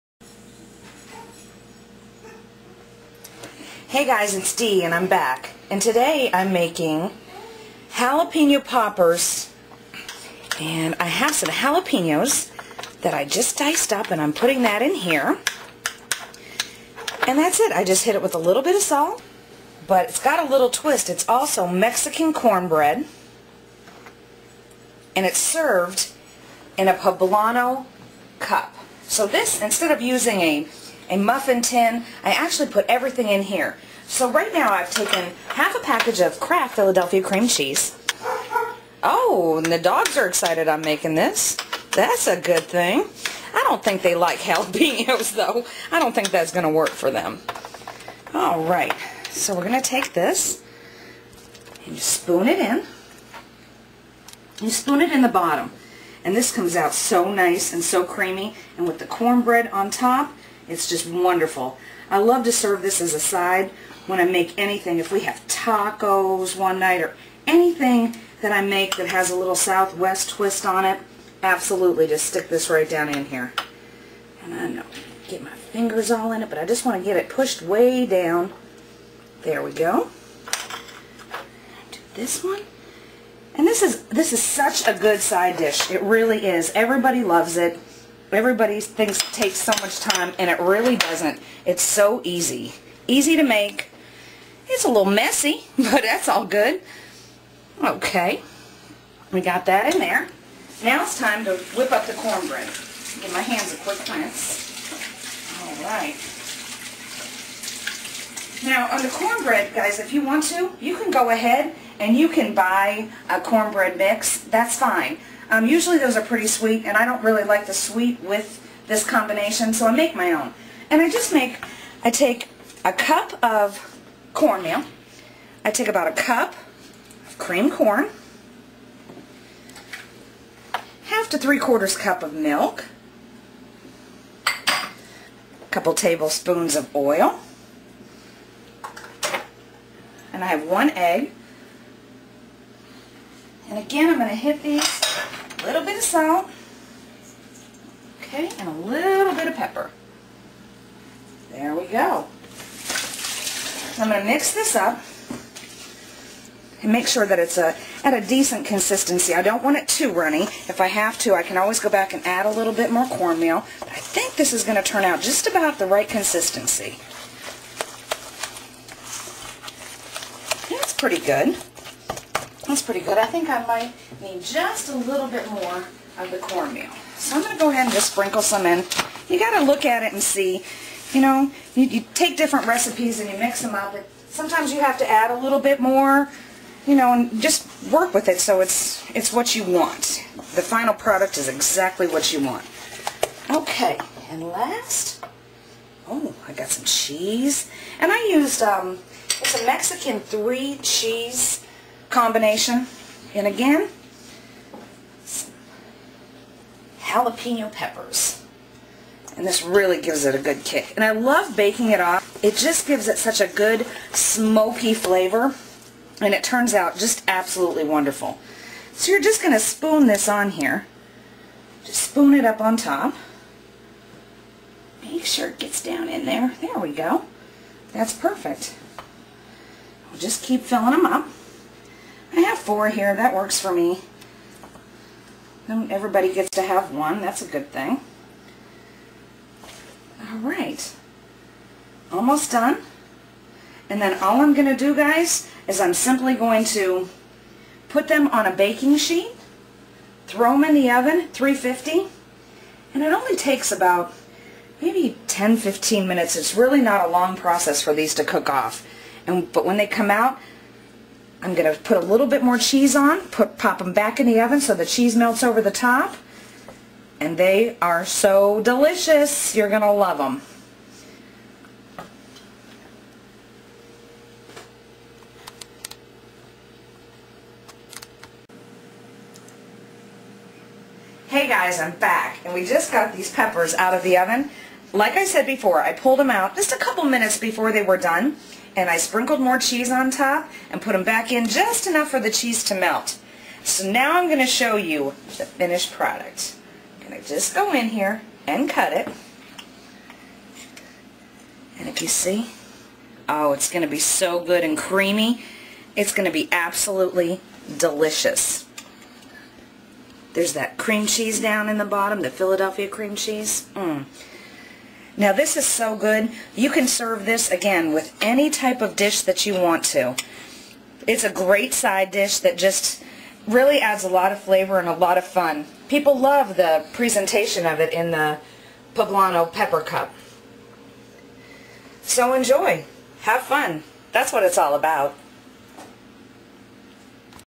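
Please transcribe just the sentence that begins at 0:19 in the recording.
But it's got a little twist.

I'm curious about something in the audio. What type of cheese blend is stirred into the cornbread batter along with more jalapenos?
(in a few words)
Mexican three cheese.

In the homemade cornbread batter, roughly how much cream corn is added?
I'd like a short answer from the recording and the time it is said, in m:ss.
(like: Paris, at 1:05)
about a cup, at 2:05.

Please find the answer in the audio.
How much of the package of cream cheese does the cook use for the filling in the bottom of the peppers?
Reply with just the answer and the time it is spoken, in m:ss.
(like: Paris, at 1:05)
half a package, at 0:35.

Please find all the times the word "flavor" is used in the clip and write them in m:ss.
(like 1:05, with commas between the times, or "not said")
3:34, 5:24.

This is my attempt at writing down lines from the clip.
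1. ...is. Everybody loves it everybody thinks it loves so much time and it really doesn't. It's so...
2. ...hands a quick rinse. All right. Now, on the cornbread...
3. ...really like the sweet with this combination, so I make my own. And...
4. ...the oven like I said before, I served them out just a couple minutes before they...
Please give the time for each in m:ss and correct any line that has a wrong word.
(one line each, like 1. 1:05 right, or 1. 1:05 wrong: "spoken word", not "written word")
1. 1:26 wrong: "takes", not "loves"
2. 1:43 right
3. 1:57 right
4. 4:44 wrong: "pulled", not "served".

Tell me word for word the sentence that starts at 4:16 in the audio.
It's really not a long process for these to cook off.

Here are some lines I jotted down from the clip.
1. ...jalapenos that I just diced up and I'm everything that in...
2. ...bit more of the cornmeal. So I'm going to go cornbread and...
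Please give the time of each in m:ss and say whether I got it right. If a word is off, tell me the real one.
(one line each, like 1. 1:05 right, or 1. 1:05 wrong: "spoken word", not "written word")
1. 0:11 wrong: "putting", not "everything"
2. 2:55 wrong: "ahead", not "cornbread".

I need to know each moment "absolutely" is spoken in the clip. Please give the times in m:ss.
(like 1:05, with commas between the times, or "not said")
1:11, 3:37, 5:06.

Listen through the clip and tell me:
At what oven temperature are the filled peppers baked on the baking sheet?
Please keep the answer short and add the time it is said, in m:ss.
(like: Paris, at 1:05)
350, at 4:11.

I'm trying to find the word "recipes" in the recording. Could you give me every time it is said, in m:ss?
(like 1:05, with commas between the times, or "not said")
3:02.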